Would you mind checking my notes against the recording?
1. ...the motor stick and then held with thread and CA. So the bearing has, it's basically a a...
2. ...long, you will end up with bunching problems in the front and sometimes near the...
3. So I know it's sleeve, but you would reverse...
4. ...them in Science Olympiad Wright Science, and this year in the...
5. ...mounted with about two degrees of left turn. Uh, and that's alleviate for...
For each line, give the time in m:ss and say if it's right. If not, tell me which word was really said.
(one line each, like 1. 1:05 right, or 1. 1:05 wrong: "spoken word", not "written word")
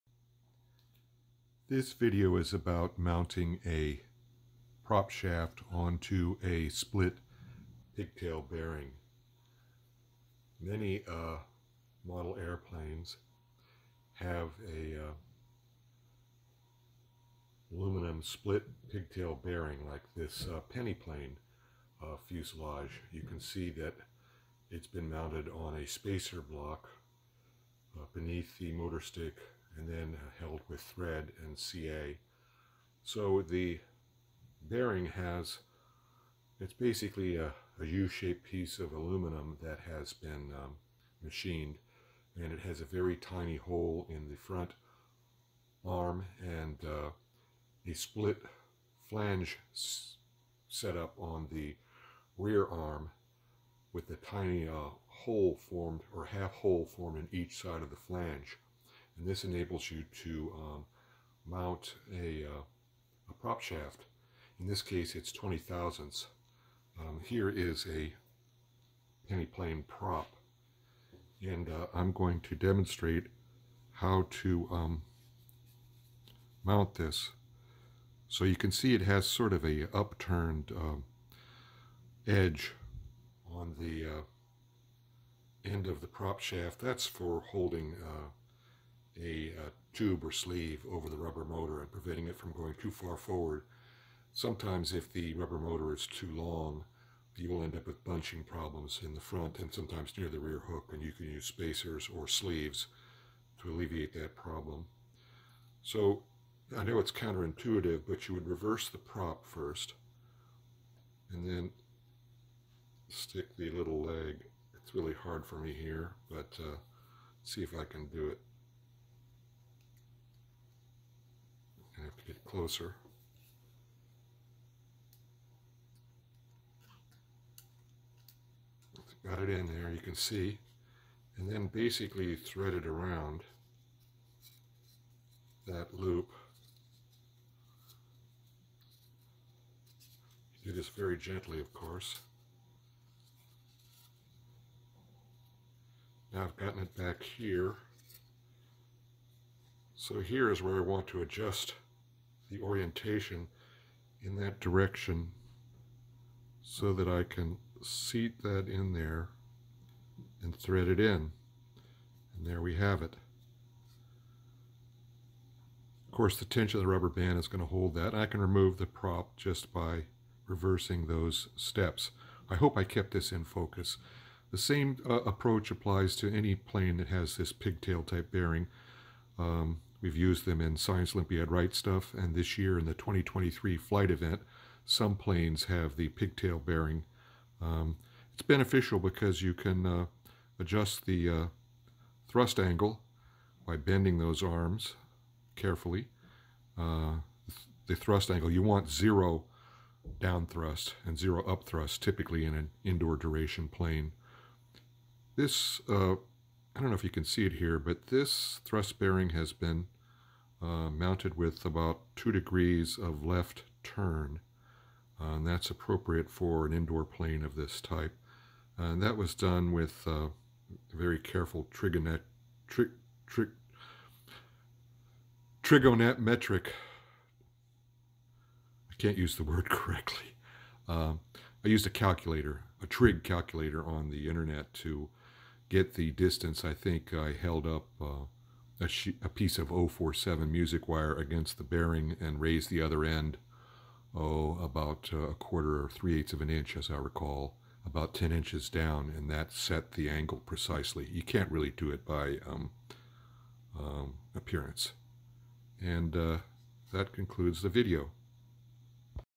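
1. 0:28 right
2. 1:36 right
3. 1:45 wrong: "counterintuitive", not "sleeve"
4. 3:00 wrong: "Stuff", not "Science"
5. 3:30 wrong: "appropriate", not "alleviate".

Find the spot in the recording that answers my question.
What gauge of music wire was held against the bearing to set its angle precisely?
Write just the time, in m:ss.
3:59.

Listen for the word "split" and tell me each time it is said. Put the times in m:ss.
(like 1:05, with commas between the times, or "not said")
0:06, 0:18, 0:47.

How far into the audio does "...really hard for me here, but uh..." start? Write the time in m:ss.
1:54.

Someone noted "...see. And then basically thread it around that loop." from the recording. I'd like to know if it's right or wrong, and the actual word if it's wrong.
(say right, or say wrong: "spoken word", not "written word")
right.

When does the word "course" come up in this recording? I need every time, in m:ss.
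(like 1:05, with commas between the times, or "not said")
2:21, 2:46.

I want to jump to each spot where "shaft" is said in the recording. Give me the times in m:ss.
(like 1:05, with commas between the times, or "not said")
0:05, 1:03, 1:26.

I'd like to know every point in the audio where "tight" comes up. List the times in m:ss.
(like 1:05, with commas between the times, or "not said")
not said.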